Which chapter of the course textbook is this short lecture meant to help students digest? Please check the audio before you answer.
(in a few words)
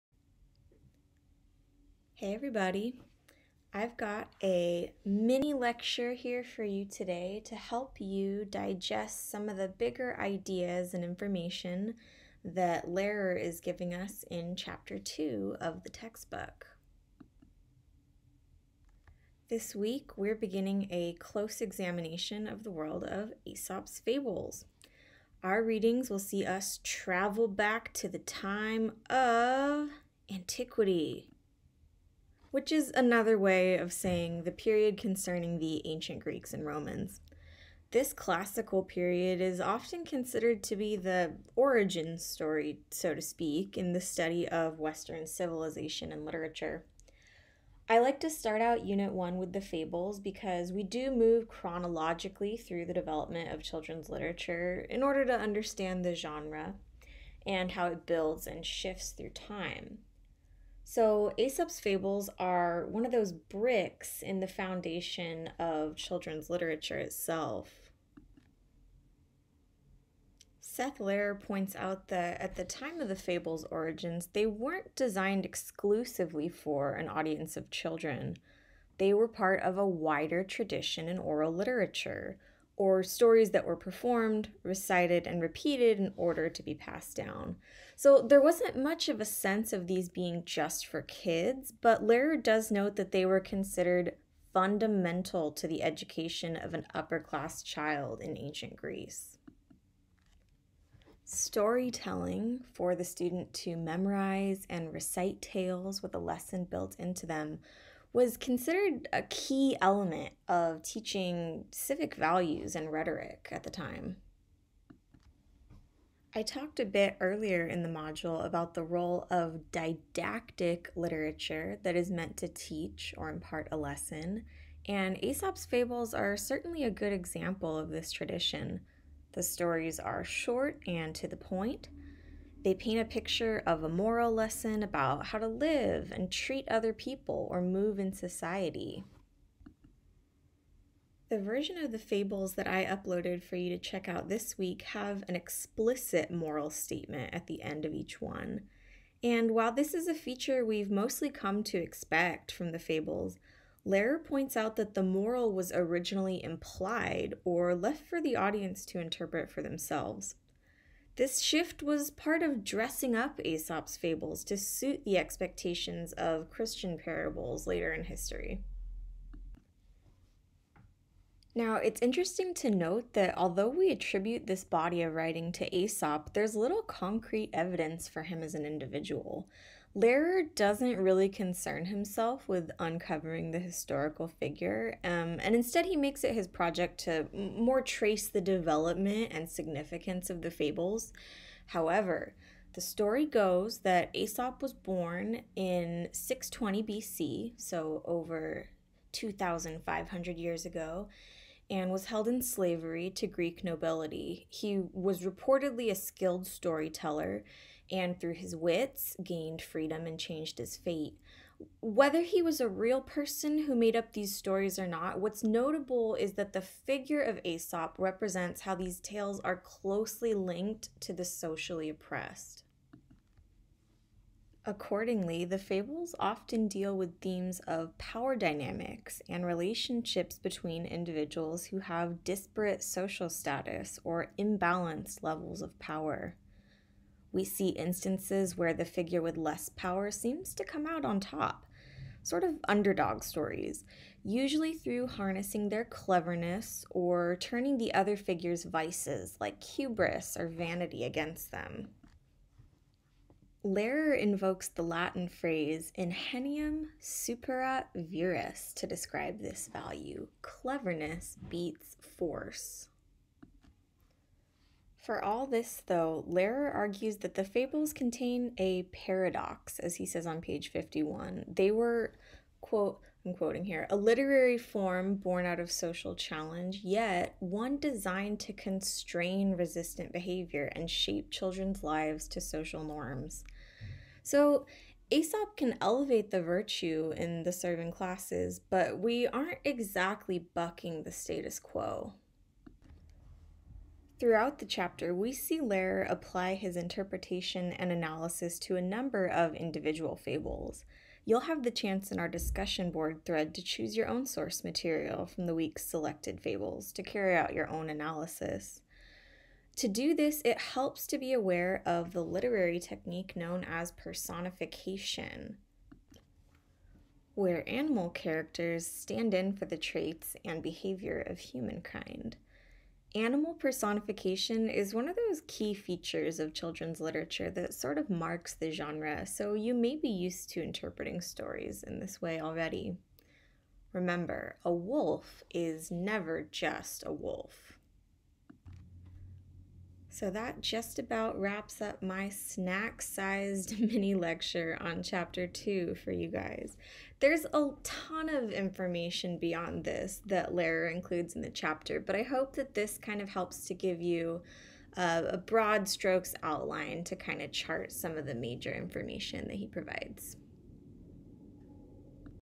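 2.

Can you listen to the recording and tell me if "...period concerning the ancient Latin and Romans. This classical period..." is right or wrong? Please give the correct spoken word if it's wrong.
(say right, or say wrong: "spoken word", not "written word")
wrong: "Greeks", not "Latin".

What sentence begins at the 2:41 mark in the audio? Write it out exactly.
This shift was part of dressing up Aesop's fables to suit the expectations of Christian parables later in history.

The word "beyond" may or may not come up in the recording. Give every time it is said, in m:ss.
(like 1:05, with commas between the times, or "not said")
5:49.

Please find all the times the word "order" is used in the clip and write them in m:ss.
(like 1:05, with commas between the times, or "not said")
0:55, 1:26.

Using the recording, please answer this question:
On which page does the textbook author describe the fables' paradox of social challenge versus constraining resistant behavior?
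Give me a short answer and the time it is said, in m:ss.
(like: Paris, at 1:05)
51, at 4:30.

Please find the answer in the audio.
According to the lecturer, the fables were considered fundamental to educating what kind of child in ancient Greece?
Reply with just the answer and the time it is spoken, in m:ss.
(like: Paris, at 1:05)
upper class child, at 1:36.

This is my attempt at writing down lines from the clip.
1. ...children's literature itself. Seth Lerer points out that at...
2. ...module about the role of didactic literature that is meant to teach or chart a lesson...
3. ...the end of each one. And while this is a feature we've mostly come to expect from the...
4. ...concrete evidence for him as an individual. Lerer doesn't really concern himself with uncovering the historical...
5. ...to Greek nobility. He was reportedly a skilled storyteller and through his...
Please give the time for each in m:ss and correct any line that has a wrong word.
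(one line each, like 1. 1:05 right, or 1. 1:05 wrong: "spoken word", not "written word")
1. 1:05 right
2. 1:57 wrong: "impart", not "chart"
3. 2:27 right
4. 2:56 right
5. 3:23 right.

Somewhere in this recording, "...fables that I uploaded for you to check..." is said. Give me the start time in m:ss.
2:21.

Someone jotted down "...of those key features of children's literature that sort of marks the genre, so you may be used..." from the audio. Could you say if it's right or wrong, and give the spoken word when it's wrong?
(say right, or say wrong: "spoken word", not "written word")
right.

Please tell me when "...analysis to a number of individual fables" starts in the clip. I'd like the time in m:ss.
4:57.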